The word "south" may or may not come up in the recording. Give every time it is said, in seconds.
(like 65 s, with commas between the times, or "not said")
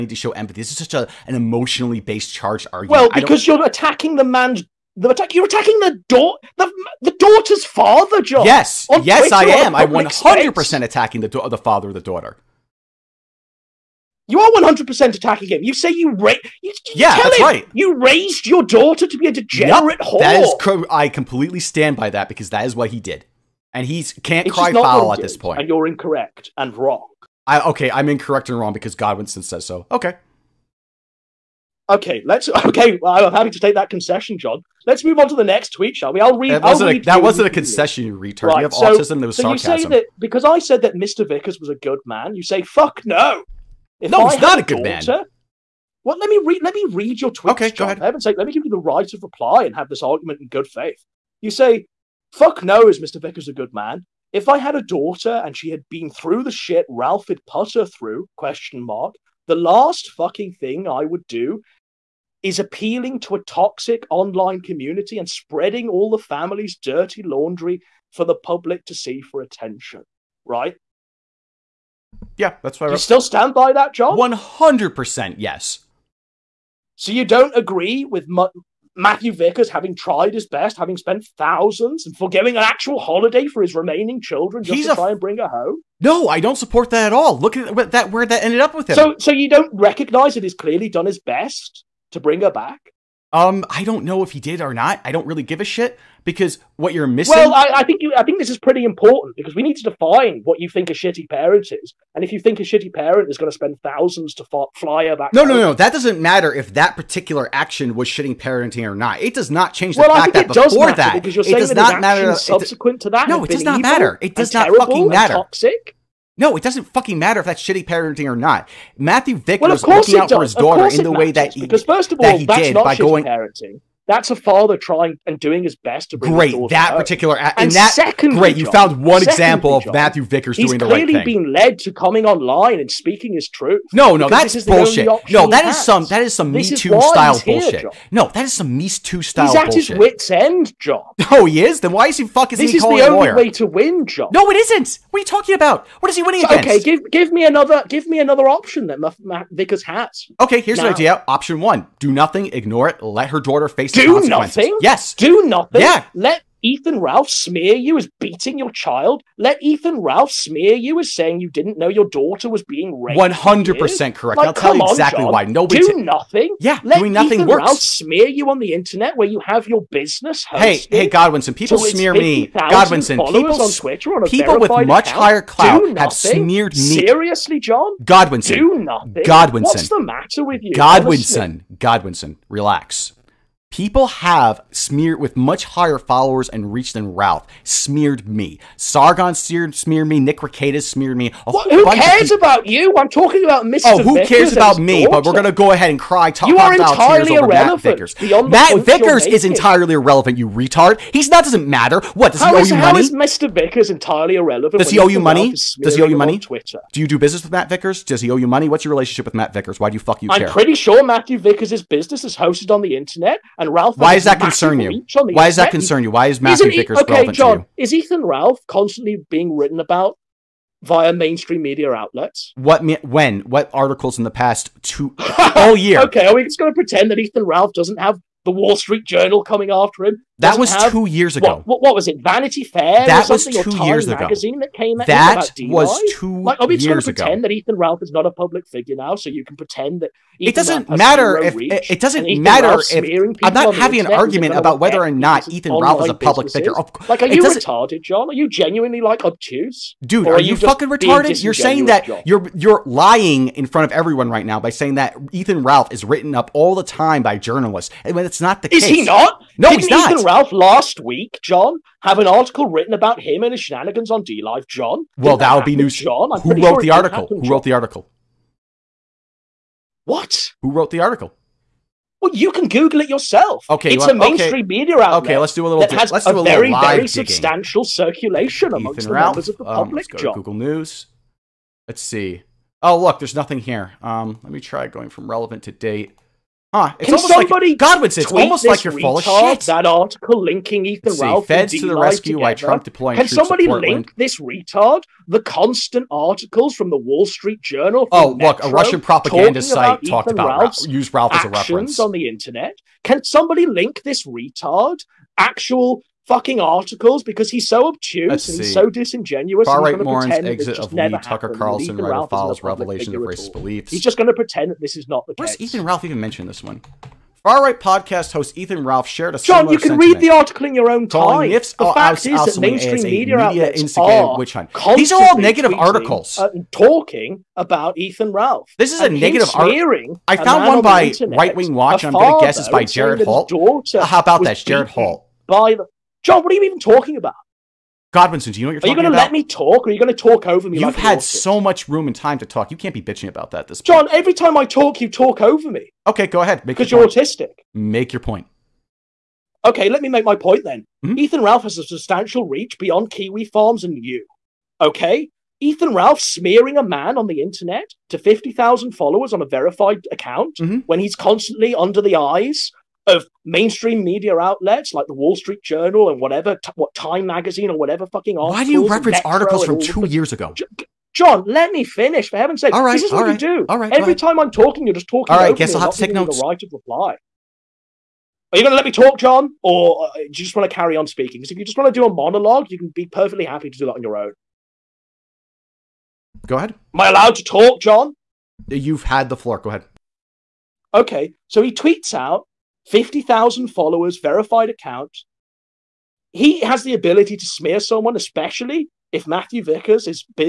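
not said.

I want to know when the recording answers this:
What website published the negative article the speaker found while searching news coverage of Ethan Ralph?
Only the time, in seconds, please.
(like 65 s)
331 s.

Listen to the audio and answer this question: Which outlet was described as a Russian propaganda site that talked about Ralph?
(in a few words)
Metro.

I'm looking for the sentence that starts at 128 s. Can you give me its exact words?
You found one example of job, Matthew Vickers doing the right thing.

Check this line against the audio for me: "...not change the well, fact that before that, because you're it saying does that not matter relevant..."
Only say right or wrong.
wrong.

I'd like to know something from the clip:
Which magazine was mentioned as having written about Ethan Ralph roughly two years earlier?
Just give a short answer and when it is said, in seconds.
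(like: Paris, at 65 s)
Vanity Fair, at 232 s.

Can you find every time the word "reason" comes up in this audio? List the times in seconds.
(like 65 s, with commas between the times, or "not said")
not said.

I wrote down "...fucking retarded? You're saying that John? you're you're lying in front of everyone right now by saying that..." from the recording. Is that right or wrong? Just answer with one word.
right.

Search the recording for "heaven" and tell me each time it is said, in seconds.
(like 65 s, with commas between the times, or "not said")
48 s, 372 s.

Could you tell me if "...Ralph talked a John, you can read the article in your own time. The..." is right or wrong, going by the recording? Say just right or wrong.
wrong.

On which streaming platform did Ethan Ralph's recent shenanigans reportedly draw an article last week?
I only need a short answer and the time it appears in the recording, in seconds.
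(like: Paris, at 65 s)
DLive, at 264 s.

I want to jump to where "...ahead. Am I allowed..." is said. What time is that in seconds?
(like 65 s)
386 s.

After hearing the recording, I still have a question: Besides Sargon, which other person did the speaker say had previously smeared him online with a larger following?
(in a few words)
Nick Rekieta.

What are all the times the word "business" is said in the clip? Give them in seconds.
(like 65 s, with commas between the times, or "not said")
169 s, 207 s, 211 s.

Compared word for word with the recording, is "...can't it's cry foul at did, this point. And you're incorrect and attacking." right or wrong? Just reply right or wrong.
wrong.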